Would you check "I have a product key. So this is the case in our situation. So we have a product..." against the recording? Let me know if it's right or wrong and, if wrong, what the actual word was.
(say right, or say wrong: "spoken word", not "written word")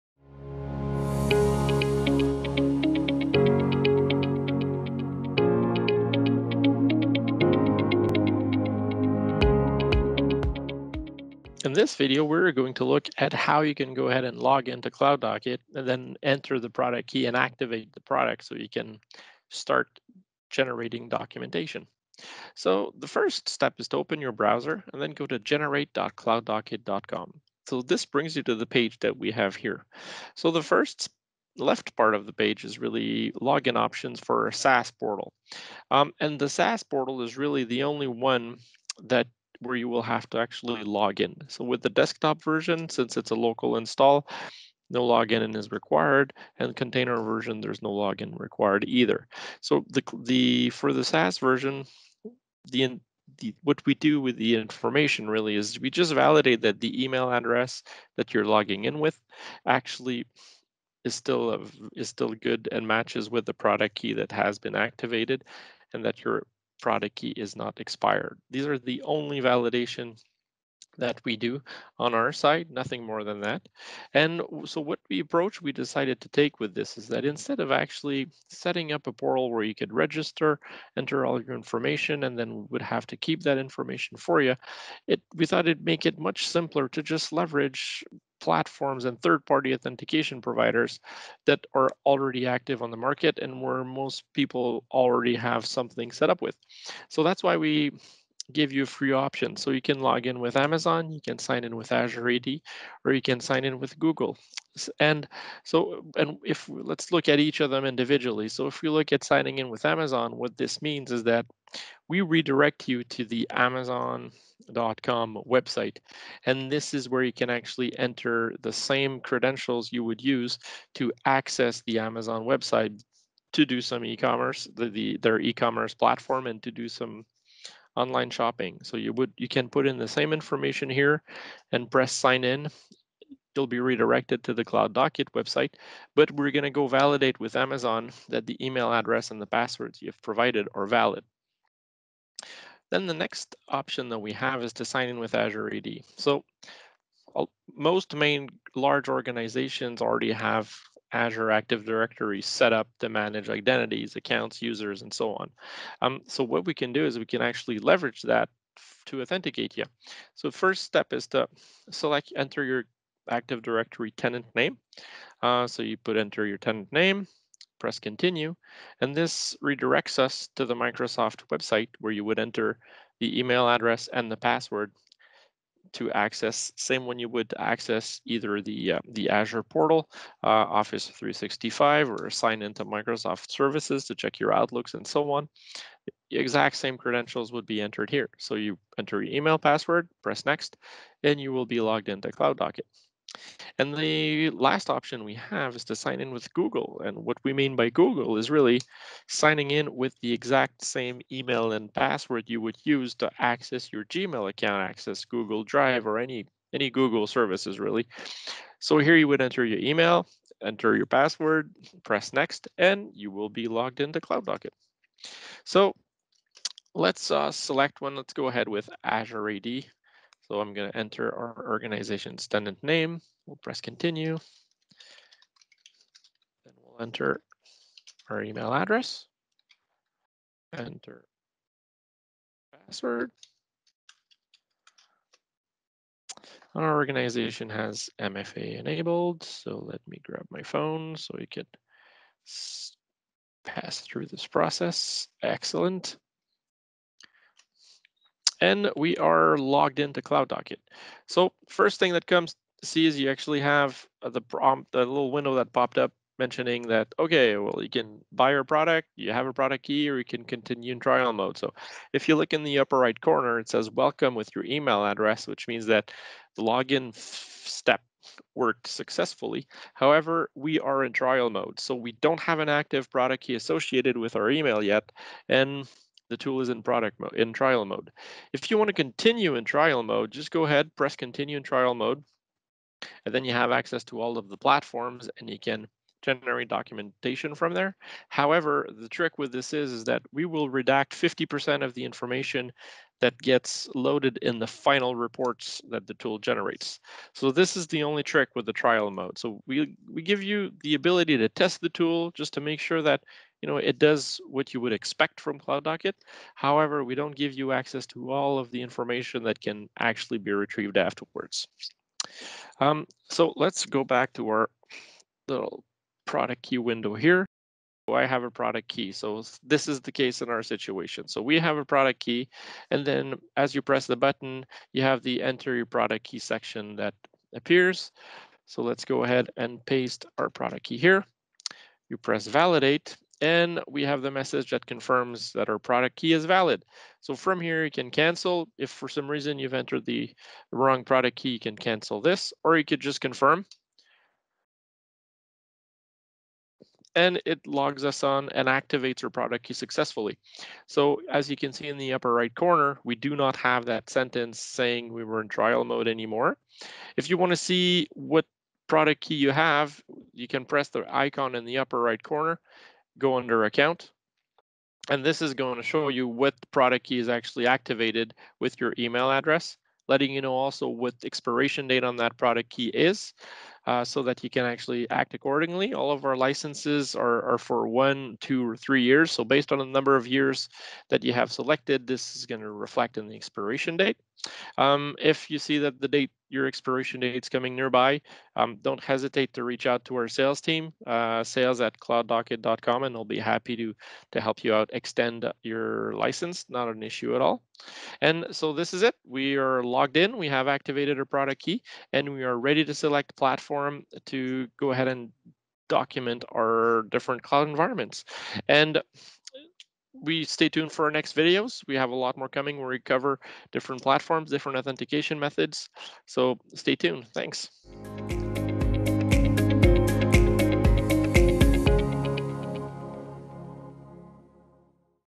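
right.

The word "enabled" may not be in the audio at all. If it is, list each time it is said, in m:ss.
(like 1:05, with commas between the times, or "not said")
3:58.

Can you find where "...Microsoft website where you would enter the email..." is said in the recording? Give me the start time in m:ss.
2:50.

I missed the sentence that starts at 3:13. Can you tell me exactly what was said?
And the last option we have is to sign in with Google.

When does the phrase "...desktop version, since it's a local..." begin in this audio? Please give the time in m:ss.
0:41.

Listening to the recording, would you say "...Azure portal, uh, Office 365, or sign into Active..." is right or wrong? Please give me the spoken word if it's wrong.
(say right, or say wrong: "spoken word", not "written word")
wrong: "Microsoft", not "Active".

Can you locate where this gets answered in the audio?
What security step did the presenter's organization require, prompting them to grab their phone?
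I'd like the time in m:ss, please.
3:58.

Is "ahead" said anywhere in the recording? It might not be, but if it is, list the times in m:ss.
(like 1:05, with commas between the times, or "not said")
0:14, 3:38, 4:40, 5:29, 6:44.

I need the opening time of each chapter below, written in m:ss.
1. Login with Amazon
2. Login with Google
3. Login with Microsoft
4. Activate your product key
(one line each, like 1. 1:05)
1. 1:48
2. 3:14
3. 2:30
4. 5:13.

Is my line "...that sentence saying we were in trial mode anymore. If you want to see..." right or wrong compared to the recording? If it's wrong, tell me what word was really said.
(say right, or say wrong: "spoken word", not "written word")
right.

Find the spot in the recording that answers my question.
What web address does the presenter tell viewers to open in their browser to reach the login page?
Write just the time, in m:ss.
0:25.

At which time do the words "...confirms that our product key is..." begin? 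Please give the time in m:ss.
5:34.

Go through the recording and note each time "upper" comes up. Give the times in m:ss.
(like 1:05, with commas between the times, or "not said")
4:22, 5:52, 6:01.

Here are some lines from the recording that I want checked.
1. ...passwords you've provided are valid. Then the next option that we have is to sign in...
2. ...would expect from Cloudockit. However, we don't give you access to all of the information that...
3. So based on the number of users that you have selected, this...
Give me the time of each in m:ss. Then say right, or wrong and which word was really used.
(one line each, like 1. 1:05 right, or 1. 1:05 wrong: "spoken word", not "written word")
1. 2:19 right
2. 5:04 right
3. 6:19 wrong: "years", not "users".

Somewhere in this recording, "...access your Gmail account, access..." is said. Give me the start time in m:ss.
3:23.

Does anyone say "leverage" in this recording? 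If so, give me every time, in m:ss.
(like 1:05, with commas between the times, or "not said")
1:27, 2:37.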